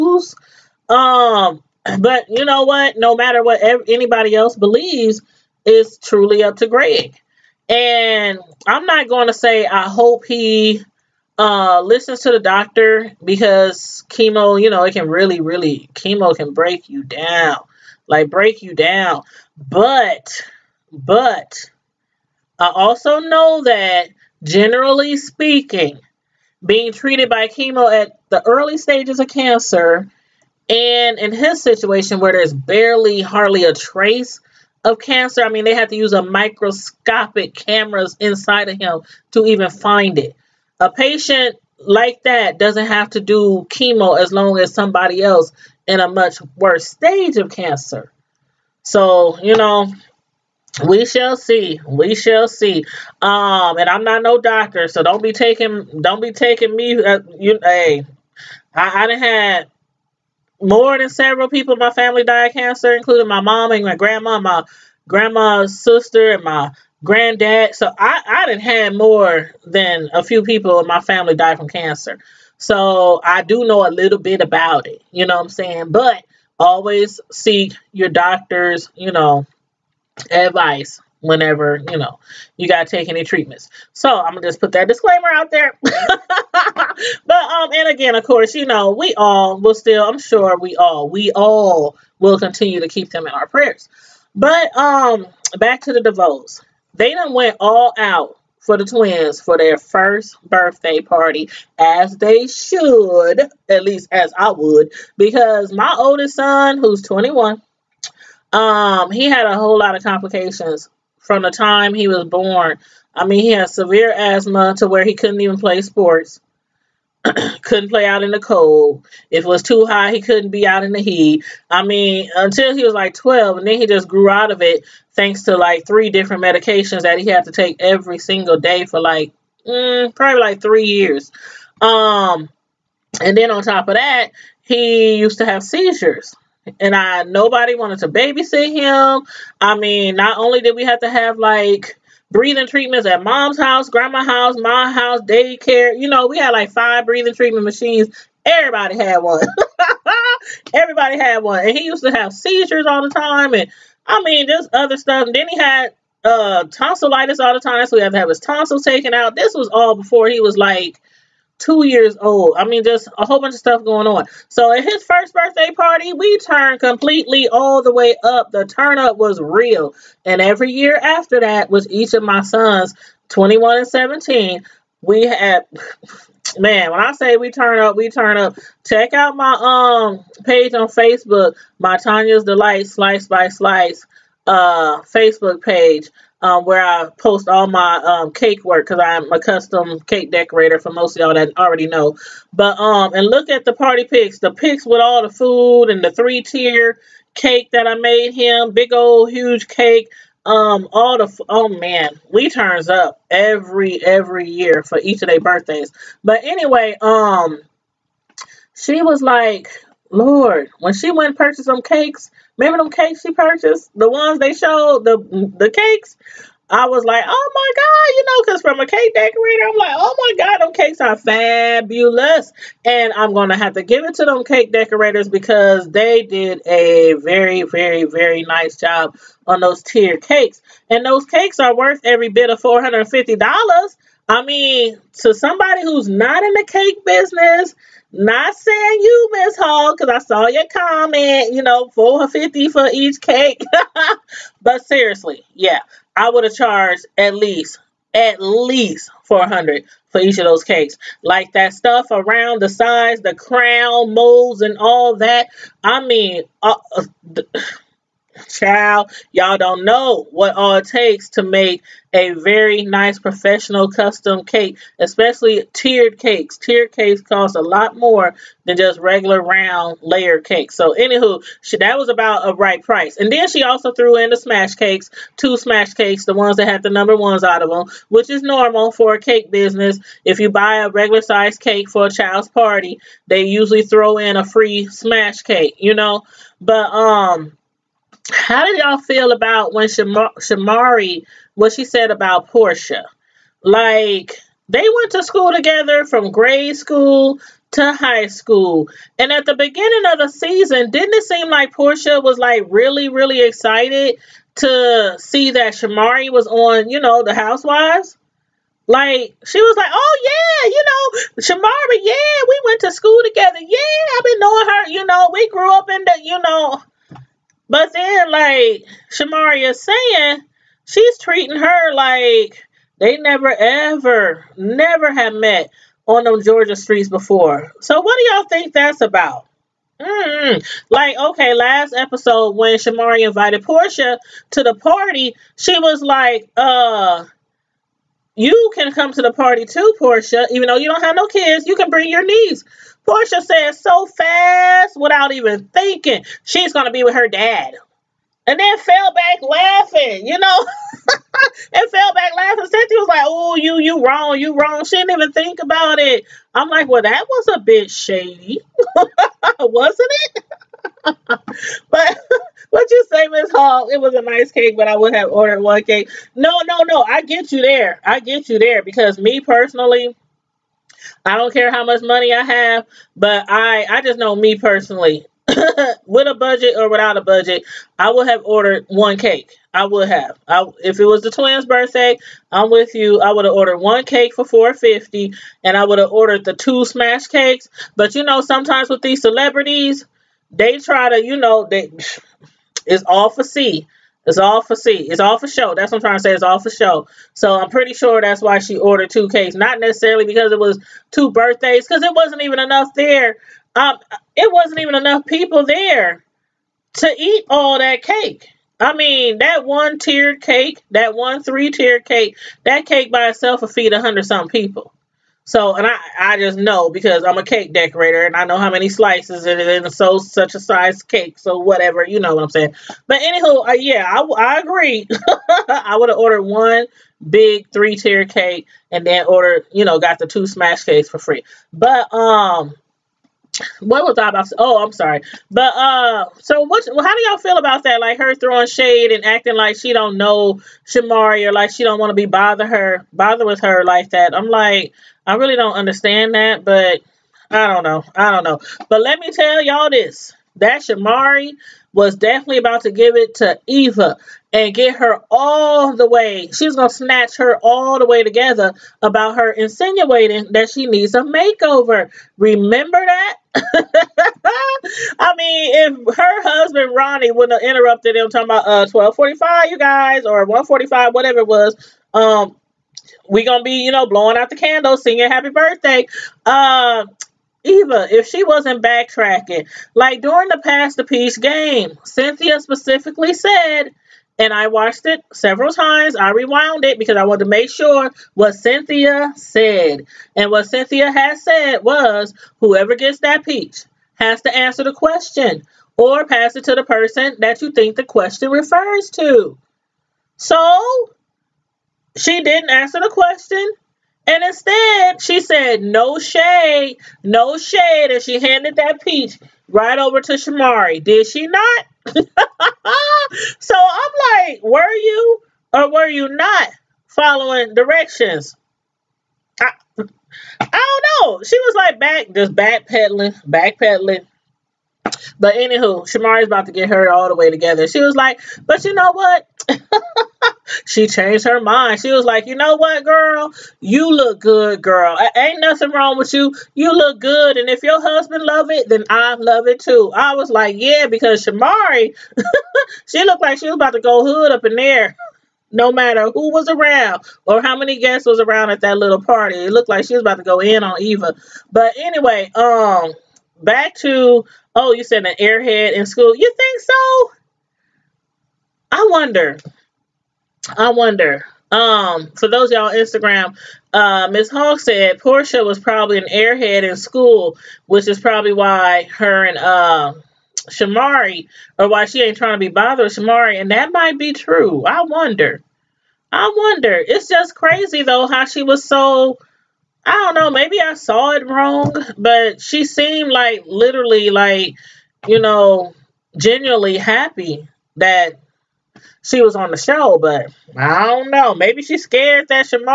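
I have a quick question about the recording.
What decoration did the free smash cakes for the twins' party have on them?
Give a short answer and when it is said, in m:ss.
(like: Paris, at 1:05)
number ones, at 4:36.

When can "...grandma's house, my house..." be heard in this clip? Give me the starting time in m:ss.
2:23.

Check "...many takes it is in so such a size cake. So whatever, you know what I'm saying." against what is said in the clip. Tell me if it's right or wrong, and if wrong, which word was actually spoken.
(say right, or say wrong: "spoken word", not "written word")
wrong: "slices", not "takes".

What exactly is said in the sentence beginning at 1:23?
So I'm gonna just put that disclaimer out there.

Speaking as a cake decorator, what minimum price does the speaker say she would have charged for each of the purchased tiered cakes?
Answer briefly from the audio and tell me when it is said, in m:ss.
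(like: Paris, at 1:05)
400, at 4:09.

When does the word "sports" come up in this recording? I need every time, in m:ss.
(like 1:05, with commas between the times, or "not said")
1:55.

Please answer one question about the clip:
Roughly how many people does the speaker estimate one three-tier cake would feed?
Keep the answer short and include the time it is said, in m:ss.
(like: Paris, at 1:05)
a hundred some people, at 6:53.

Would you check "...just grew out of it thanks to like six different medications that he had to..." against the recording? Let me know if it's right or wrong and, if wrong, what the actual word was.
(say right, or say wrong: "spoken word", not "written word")
wrong: "three", not "six".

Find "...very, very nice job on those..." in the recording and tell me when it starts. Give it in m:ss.
3:47.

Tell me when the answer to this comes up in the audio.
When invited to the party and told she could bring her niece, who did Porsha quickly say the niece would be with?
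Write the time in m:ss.
5:47.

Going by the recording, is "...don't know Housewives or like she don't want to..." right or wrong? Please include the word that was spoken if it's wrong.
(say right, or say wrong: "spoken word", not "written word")
wrong: "Shamari", not "Housewives".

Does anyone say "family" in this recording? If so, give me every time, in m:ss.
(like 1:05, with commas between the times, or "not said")
1:01, 1:11.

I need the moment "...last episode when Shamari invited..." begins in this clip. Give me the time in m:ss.
5:31.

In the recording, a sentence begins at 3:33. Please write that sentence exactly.
The ones they showed, the the cakes?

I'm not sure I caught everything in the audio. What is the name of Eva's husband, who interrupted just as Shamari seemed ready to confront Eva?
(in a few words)
Ronnie.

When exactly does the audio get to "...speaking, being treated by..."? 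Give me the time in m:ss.
0:25.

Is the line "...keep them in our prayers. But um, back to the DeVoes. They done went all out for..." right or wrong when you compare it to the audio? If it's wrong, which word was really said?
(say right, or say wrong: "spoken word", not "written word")
right.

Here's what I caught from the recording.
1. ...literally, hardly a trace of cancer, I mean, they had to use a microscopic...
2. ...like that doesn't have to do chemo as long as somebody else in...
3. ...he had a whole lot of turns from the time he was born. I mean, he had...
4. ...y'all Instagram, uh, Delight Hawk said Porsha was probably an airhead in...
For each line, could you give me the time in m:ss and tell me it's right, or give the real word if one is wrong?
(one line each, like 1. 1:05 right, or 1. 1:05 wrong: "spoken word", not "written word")
1. 0:32 wrong: "barely", not "literally"
2. 0:41 right
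3. 1:49 wrong: "complications", not "turns"
4. 9:22 wrong: "Miss", not "Delight".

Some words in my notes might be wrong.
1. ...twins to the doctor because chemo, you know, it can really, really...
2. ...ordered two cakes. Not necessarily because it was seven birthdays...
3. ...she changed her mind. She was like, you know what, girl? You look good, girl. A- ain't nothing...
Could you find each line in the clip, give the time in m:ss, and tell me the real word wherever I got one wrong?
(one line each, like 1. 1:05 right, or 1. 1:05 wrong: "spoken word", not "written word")
1. 0:11 wrong: "listens", not "twins"
2. 6:38 wrong: "two", not "seven"
3. 8:50 right.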